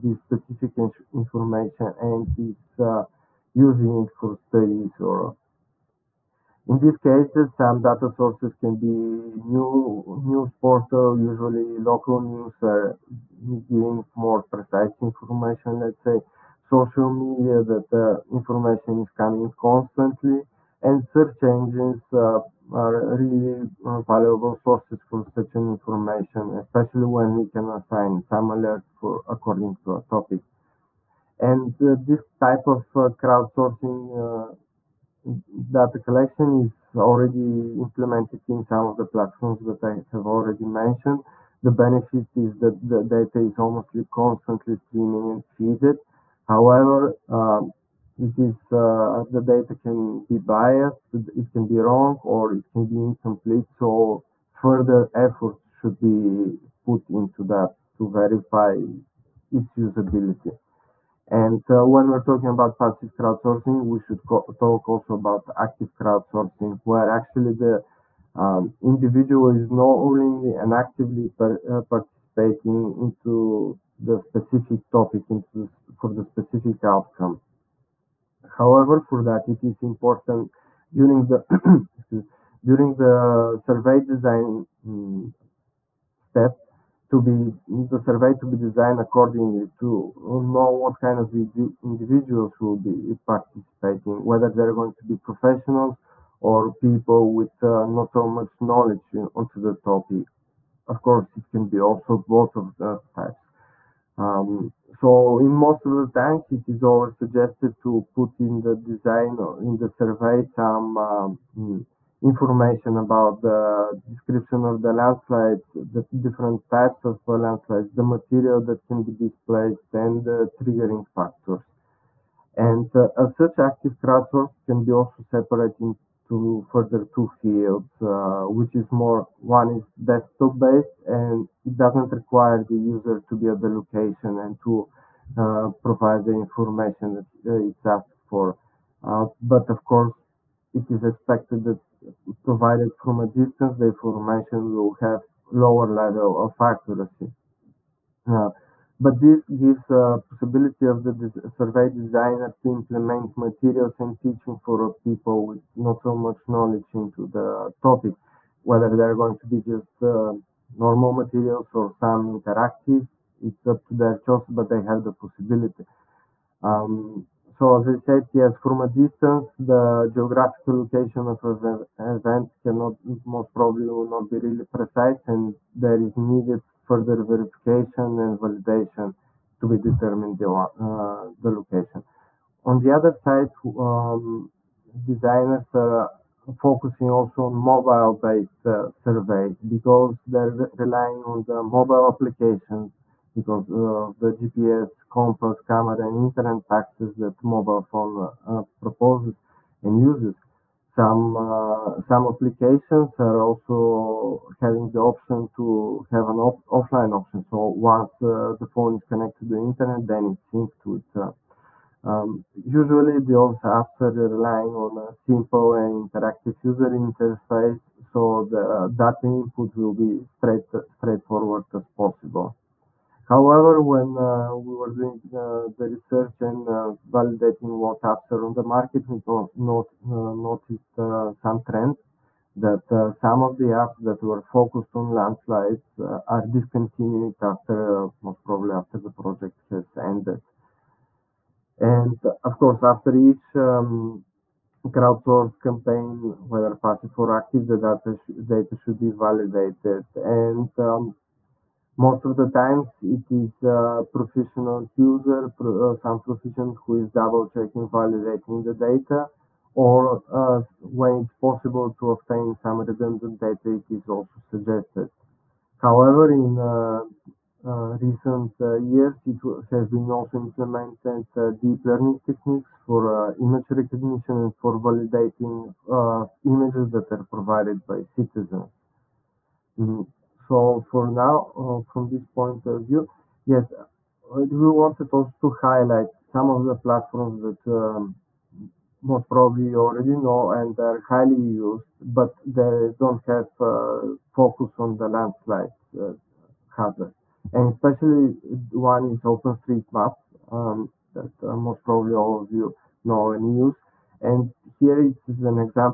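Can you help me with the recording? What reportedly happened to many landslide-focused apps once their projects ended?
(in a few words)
discontinued.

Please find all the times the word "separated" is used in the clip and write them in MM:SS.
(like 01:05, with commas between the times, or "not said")
02:05.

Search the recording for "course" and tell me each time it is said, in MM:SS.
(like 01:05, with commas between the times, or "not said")
01:41, 02:19, 04:02.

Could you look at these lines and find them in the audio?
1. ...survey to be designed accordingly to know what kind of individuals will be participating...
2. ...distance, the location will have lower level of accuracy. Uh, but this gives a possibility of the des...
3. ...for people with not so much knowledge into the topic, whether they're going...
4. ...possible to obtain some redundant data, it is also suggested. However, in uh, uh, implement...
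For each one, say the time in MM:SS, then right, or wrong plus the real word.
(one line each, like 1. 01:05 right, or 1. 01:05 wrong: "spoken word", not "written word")
1. 01:27 right
2. 02:23 wrong: "information", not "location"
3. 02:34 right
4. 04:21 wrong: "recent", not "implement".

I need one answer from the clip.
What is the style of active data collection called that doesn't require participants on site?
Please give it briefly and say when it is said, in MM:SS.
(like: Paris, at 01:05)
desktop based, at 02:10.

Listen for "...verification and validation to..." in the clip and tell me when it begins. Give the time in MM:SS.
02:57.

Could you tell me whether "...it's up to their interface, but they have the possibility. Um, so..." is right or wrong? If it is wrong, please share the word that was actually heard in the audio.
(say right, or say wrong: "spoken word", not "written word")
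wrong: "choice", not "interface".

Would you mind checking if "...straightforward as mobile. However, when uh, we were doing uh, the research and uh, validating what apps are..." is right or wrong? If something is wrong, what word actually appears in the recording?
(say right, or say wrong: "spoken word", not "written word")
wrong: "possible", not "mobile".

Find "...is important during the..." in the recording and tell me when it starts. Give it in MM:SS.
01:19.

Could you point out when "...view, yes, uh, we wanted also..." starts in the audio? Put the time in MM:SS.
04:42.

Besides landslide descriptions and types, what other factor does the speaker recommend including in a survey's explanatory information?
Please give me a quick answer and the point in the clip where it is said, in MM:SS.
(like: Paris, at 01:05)
triggering factors, at 02:00.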